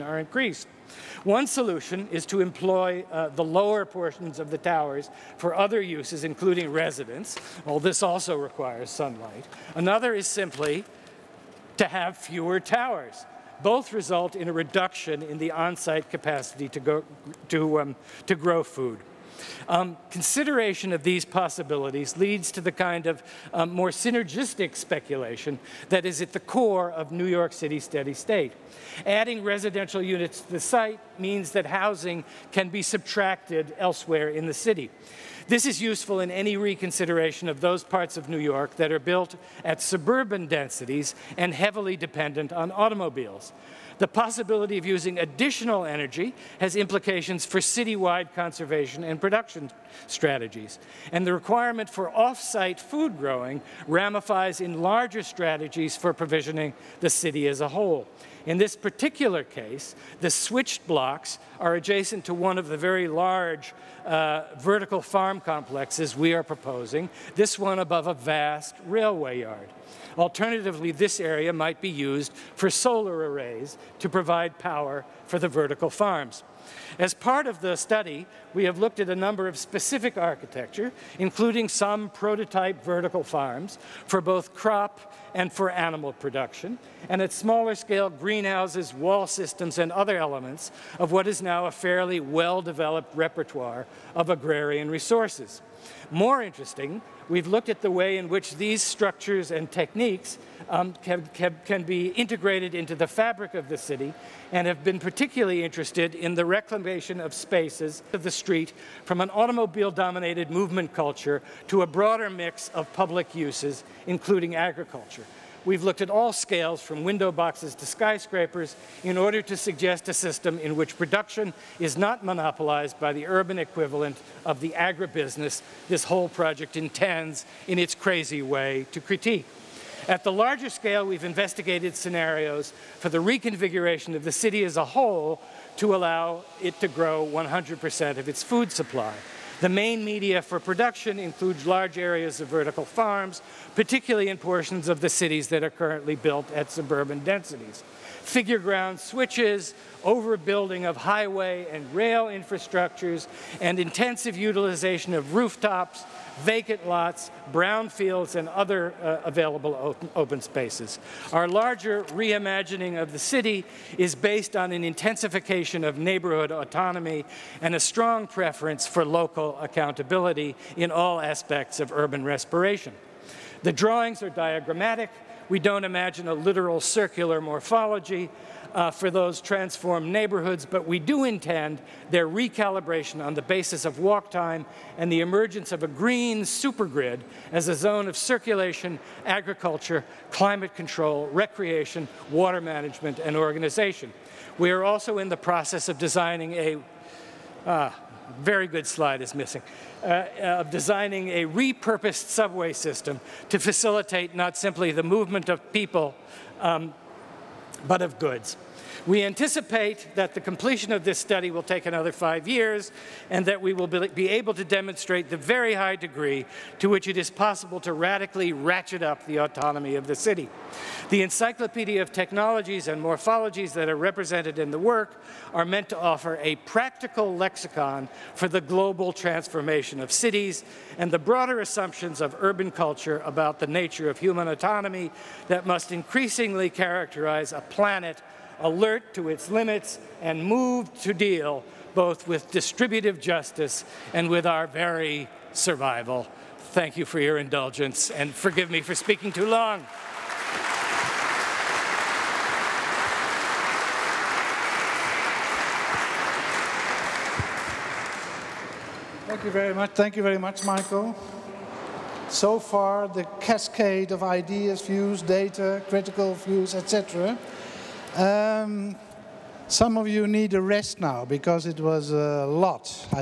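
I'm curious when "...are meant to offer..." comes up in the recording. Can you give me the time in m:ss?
3:45.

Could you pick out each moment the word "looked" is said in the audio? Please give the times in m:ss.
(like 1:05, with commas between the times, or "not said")
1:18, 1:37, 1:55.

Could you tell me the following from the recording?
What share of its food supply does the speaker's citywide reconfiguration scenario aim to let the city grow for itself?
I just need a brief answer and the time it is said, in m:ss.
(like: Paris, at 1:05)
100%, at 2:17.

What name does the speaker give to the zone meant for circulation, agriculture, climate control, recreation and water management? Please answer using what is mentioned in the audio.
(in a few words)
green supergrid.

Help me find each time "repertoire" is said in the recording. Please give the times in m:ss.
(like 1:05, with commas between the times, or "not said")
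1:33.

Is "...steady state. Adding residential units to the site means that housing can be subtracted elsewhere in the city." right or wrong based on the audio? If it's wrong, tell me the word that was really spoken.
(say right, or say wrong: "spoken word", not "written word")
right.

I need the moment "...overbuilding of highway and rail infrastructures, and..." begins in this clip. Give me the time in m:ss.
2:30.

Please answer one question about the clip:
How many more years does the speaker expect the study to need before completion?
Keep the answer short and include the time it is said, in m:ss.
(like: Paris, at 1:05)
5, at 3:32.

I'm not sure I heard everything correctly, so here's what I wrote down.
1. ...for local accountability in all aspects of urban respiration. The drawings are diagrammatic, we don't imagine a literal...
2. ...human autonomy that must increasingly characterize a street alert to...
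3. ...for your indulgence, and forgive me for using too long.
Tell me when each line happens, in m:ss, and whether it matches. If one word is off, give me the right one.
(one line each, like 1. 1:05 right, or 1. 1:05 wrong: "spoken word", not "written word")
1. 2:48 right
2. 3:54 wrong: "planet", not "street"
3. 4:07 wrong: "speaking", not "using".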